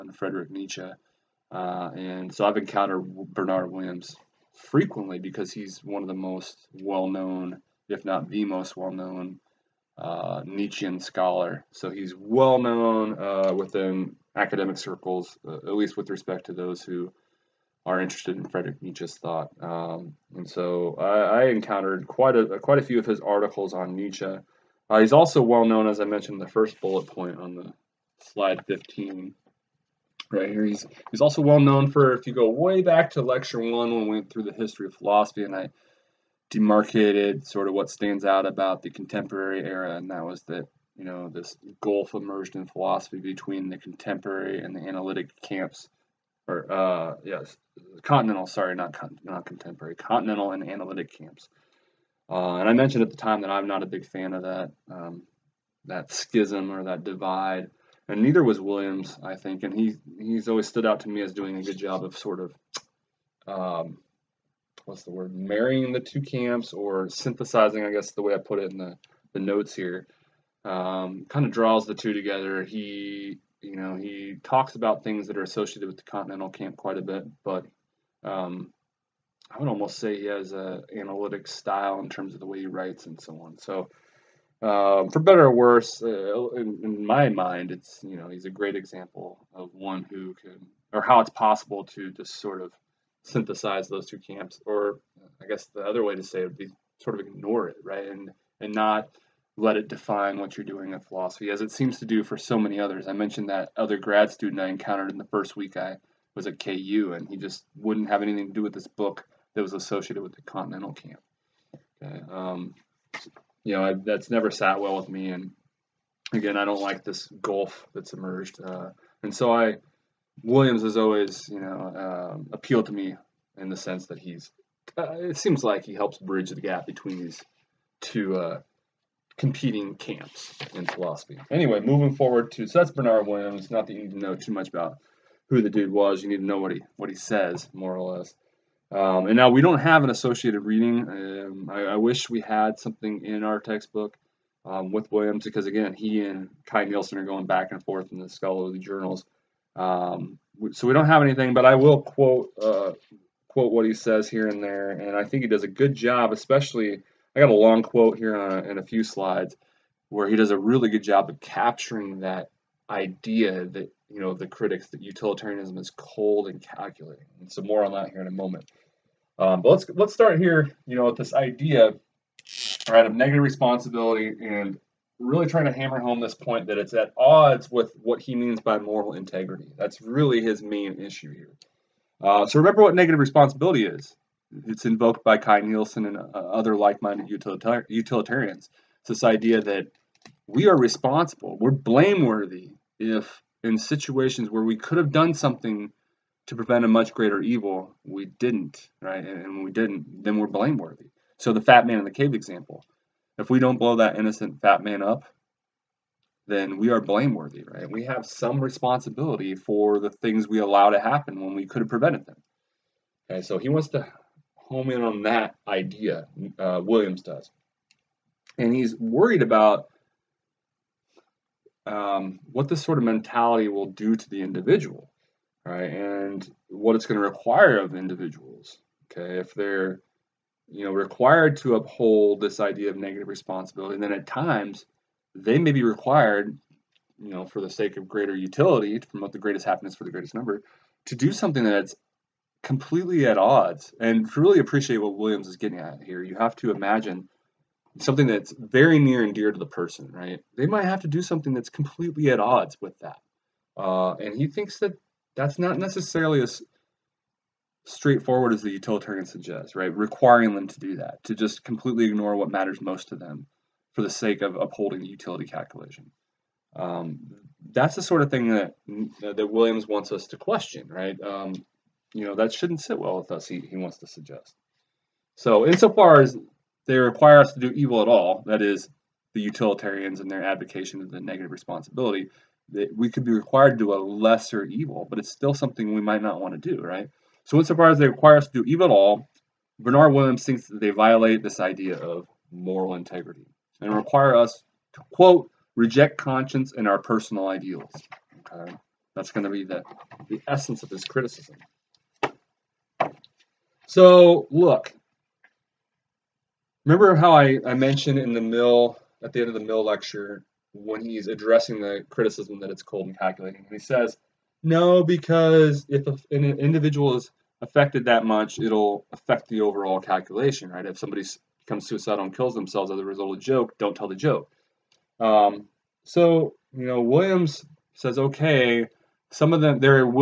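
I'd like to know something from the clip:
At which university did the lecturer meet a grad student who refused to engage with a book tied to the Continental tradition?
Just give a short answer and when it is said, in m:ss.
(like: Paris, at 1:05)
KU, at 1:46.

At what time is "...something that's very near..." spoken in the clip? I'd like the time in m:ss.
4:07.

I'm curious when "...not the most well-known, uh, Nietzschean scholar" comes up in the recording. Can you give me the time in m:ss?
0:08.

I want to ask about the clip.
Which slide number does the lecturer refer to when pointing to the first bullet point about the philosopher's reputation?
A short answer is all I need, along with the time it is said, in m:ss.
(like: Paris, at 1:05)
15, at 0:28.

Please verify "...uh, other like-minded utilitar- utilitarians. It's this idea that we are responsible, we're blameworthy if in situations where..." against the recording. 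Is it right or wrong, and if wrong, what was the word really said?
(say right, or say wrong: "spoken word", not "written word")
right.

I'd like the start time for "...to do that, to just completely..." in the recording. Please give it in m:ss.
4:20.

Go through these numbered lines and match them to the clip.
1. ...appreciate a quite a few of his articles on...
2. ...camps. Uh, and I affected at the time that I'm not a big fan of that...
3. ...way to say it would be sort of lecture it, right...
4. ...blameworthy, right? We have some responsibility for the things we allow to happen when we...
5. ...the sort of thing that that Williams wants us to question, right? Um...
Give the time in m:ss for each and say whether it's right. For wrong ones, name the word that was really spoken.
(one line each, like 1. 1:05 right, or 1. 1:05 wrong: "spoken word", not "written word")
1. 0:22 wrong: "quite", not "appreciate"
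2. 0:51 wrong: "mentioned", not "affected"
3. 1:36 wrong: "ignore", not "lecture"
4. 3:26 right
5. 4:27 right.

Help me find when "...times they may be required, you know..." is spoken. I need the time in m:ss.
3:54.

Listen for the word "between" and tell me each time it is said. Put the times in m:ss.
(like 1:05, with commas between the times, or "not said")
0:43, 2:06.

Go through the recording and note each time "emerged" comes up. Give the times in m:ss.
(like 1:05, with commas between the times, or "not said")
0:42, 1:58.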